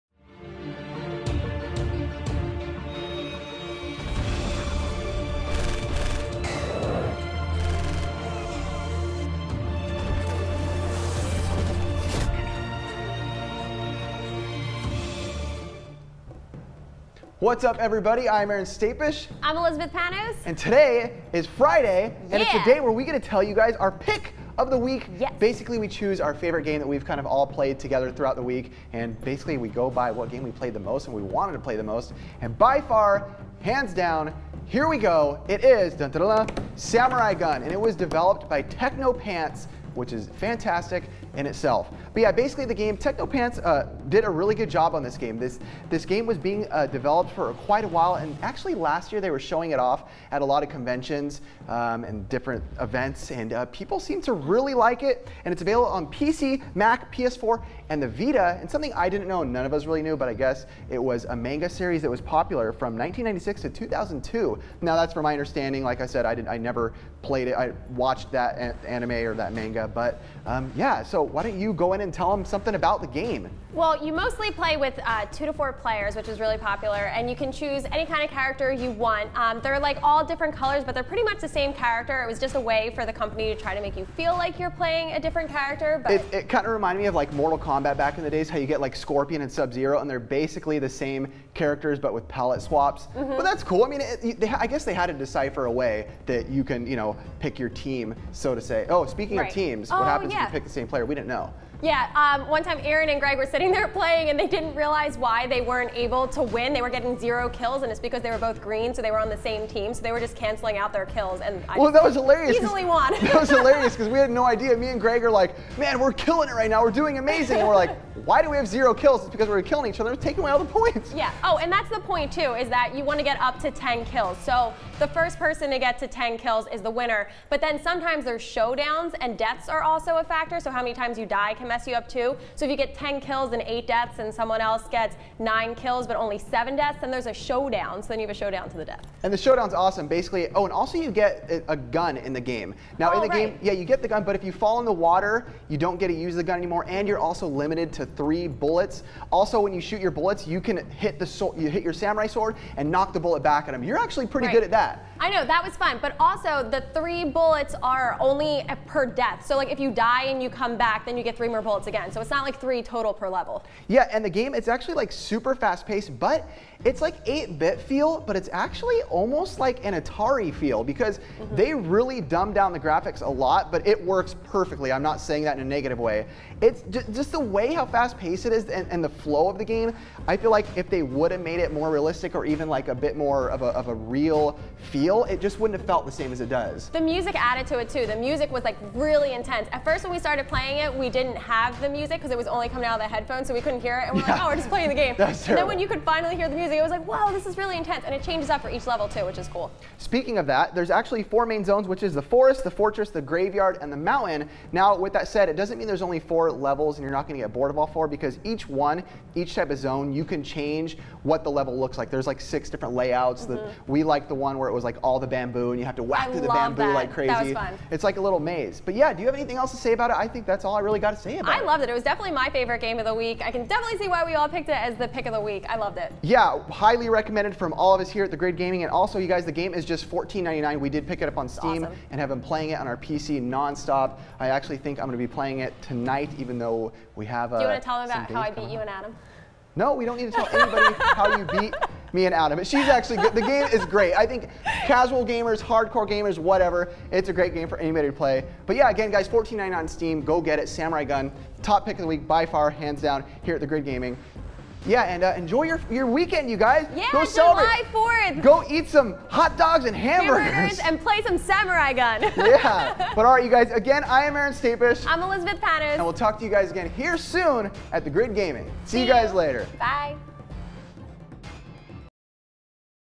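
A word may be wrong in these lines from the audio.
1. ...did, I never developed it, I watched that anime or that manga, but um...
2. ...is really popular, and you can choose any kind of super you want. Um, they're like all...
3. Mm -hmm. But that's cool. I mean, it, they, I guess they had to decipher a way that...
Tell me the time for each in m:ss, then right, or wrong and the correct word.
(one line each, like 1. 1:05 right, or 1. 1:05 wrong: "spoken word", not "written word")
1. 1:06 wrong: "played", not "developed"
2. 1:16 wrong: "character", not "super"
3. 1:33 right.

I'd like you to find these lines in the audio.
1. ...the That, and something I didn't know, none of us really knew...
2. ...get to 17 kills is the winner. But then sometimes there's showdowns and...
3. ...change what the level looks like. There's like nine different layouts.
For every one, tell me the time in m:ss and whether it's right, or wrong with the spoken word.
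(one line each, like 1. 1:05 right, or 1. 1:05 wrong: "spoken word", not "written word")
1. 0:58 wrong: "Vita", not "That"
2. 2:05 wrong: "10", not "17"
3. 3:30 wrong: "six", not "nine".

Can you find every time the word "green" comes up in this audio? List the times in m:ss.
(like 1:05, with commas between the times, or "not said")
1:48.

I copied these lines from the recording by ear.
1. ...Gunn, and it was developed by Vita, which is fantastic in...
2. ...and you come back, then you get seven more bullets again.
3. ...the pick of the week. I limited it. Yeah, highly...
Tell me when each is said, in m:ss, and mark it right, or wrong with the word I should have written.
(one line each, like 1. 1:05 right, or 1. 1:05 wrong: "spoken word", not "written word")
1. 0:37 wrong: "Teknopants", not "Vita"
2. 2:40 wrong: "three", not "seven"
3. 3:44 wrong: "loved", not "limited".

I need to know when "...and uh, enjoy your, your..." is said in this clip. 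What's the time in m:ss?
4:15.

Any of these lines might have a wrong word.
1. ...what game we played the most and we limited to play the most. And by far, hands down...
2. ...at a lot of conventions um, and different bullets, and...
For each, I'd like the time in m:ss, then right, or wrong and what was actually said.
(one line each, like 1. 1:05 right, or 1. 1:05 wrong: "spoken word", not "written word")
1. 0:30 wrong: "wanted", not "limited"
2. 0:50 wrong: "events", not "bullets".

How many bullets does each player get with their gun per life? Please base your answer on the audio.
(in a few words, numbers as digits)
3.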